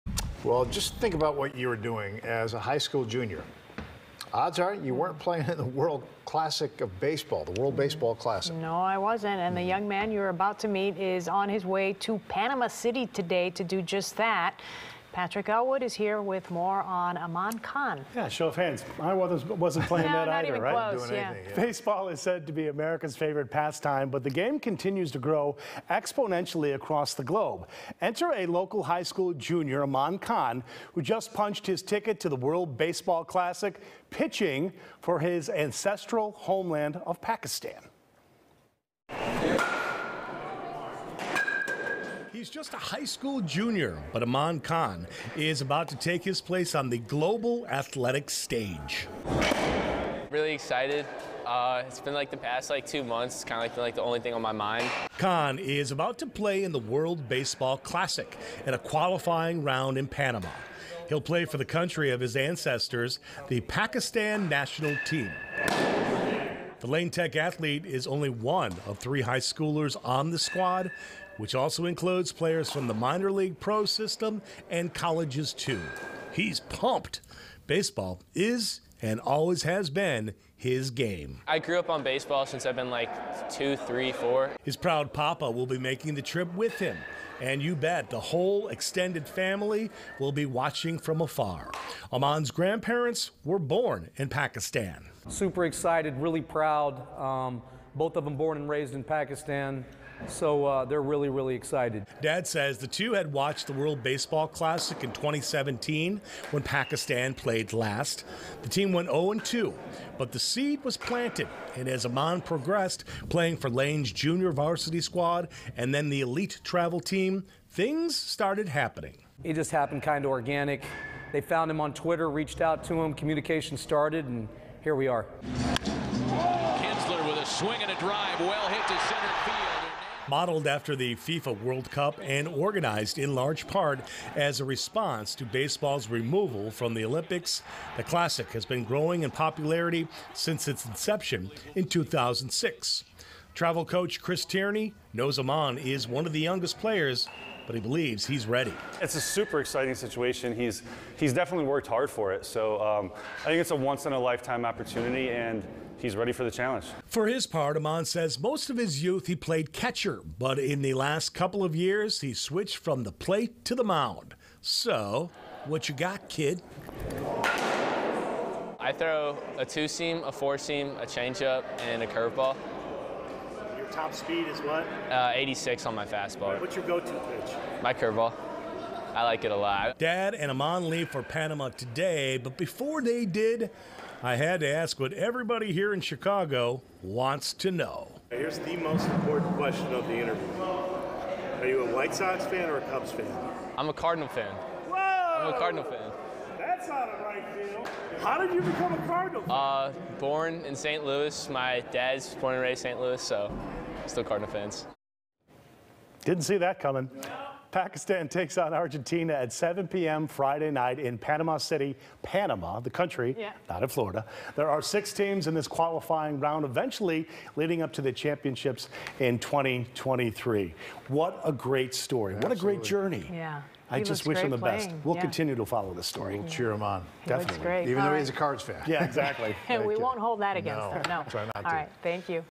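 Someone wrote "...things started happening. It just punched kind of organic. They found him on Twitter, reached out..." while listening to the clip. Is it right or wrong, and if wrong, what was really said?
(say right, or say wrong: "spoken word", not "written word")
wrong: "happened", not "punched".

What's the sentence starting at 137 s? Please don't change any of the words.
The classic has been growing in popularity since its inception in 2006.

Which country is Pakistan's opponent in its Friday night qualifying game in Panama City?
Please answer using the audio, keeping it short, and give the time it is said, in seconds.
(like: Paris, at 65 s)
Argentina, at 208 s.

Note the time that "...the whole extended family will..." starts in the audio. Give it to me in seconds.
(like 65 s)
88 s.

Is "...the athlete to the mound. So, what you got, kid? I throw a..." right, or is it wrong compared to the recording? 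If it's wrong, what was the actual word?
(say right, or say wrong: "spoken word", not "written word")
wrong: "plate", not "athlete".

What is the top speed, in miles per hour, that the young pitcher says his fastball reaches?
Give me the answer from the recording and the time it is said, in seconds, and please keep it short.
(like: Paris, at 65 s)
86, at 175 s.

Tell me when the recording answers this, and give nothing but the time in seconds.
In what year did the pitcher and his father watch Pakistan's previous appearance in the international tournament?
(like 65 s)
105 s.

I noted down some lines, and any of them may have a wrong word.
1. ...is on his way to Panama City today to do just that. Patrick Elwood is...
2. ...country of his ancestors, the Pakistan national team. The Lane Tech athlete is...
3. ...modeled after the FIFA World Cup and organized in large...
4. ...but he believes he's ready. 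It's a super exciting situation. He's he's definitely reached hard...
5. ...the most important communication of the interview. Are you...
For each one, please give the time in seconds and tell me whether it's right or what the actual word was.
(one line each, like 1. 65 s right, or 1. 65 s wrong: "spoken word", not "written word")
1. 10 s right
2. 61 s right
3. 130 s right
4. 147 s wrong: "worked", not "reached"
5. 188 s wrong: "question", not "communication".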